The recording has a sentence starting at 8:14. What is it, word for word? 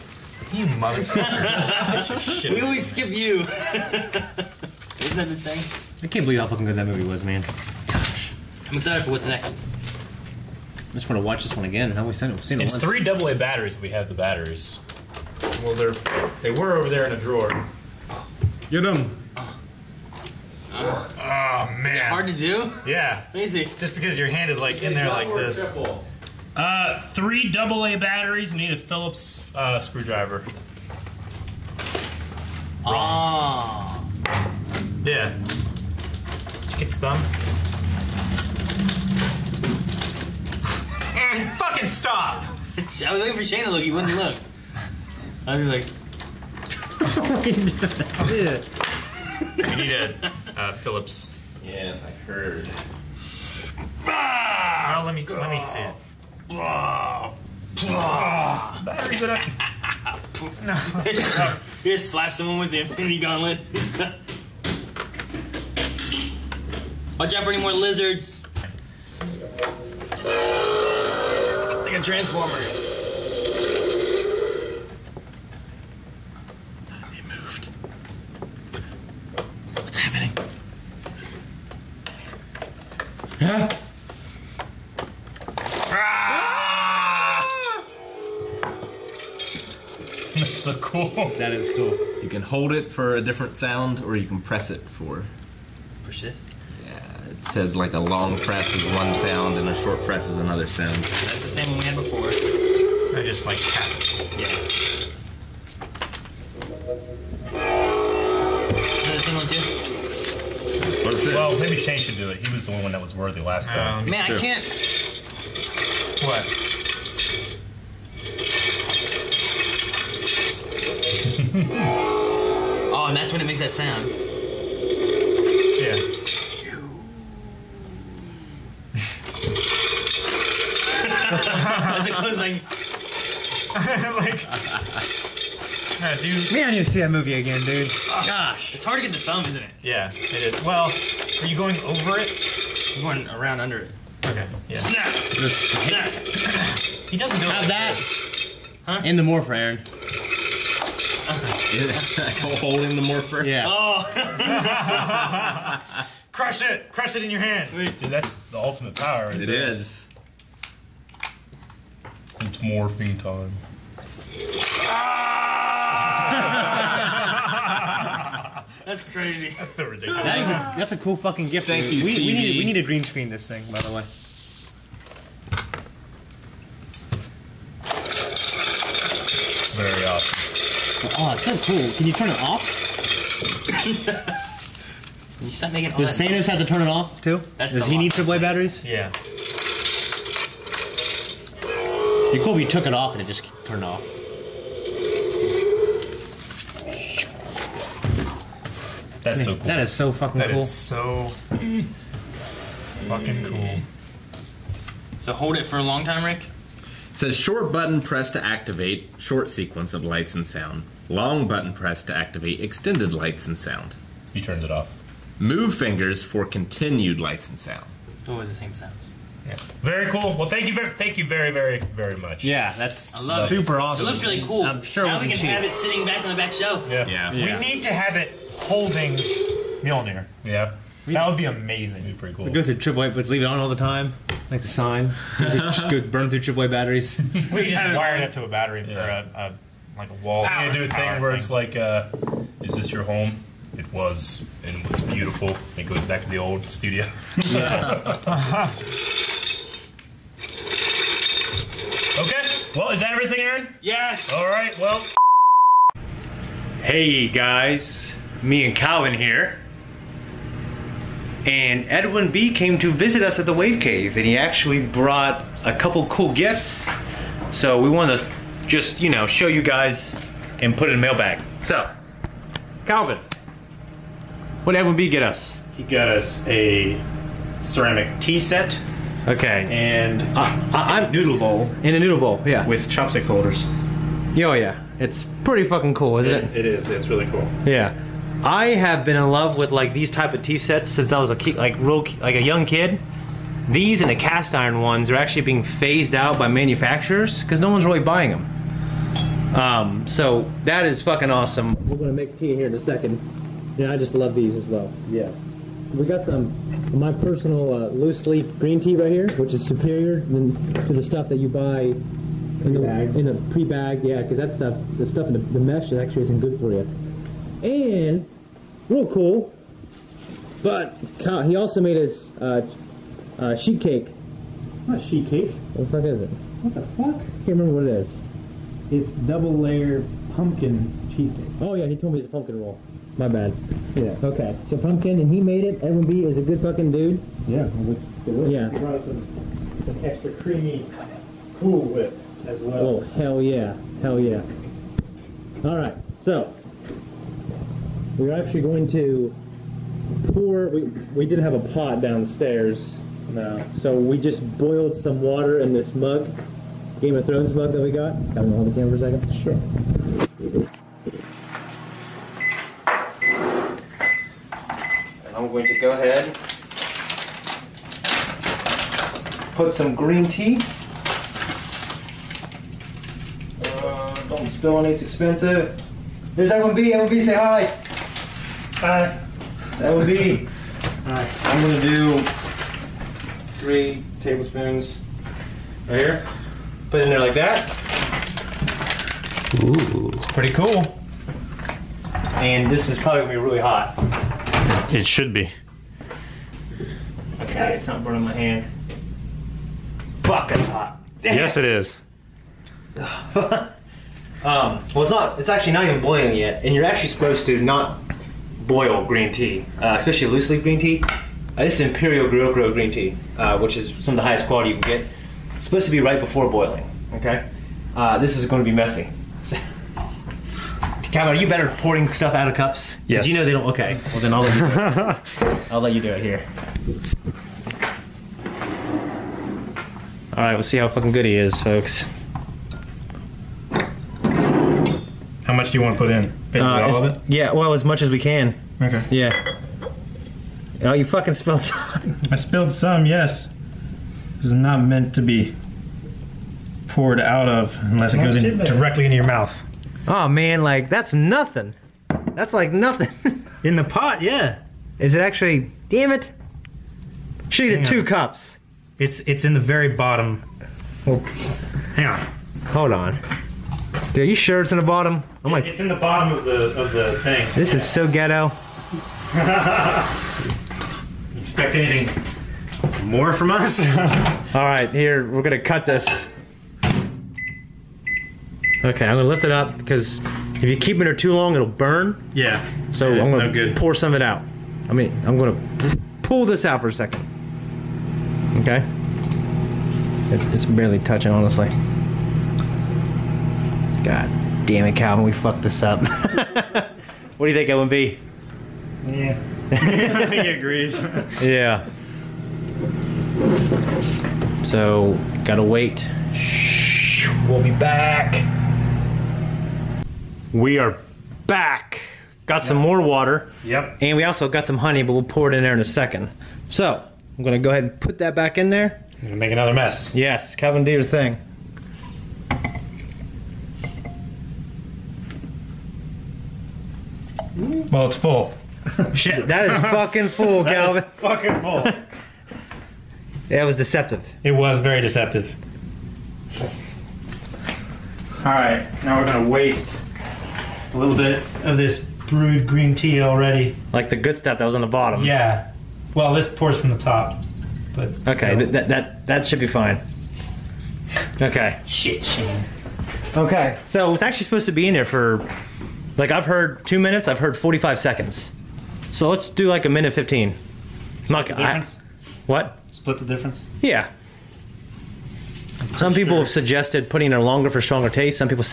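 God damn it, Calvin, we fucked this up.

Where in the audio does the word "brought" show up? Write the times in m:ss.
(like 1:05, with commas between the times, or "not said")
4:24, 5:38.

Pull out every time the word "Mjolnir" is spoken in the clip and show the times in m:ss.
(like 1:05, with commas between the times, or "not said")
3:49.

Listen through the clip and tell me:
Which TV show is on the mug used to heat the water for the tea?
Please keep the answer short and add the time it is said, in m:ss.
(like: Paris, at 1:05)
Game of Thrones, at 5:56.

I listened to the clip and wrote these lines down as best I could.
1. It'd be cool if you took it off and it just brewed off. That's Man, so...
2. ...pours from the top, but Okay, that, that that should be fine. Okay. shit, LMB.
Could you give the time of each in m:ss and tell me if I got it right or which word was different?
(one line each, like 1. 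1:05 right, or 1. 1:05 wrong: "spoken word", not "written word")
1. 3:11 wrong: "turned", not "brewed"
2. 9:06 wrong: "Shane", not "LMB".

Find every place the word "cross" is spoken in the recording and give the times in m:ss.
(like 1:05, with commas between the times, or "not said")
not said.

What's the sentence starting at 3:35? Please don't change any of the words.
Move fingers for continued lights and sound.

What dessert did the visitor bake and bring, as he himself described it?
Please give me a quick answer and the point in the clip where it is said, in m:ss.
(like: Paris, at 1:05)
pumpkin roll, at 5:32.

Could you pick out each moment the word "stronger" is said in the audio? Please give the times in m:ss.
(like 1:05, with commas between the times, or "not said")
9:27.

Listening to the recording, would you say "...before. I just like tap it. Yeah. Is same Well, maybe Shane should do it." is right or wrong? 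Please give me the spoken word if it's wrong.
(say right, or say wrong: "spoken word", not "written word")
right.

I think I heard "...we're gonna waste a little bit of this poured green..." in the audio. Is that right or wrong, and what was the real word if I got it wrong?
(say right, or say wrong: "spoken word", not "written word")
wrong: "brewed", not "poured".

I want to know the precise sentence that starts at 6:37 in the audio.
Okay, it's not burning my hand.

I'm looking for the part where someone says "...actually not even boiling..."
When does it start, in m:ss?
6:45.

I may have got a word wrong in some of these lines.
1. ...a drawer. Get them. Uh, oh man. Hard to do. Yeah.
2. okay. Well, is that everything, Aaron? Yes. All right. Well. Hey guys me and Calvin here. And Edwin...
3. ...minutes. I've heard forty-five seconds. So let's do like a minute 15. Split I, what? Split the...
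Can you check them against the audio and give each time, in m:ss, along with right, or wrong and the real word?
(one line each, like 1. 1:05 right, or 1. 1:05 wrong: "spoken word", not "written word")
1. 0:17 right
2. 4:12 right
3. 9:16 right.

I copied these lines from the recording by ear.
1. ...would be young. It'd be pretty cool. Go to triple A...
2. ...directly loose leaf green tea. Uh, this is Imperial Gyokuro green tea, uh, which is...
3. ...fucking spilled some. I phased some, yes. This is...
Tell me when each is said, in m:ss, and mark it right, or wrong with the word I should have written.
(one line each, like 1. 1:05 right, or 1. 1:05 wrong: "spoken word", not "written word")
1. 3:51 wrong: "amazing", not "young"
2. 6:49 wrong: "especially", not "directly"
3. 7:21 wrong: "spilled", not "phased".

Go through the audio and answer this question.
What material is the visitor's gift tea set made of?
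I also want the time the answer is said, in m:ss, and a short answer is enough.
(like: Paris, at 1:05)
ceramic, at 4:37.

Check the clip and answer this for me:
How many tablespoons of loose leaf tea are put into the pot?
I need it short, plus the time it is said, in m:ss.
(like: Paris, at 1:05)
3, at 6:23.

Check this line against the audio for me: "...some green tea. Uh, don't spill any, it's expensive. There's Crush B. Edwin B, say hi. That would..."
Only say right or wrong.
wrong.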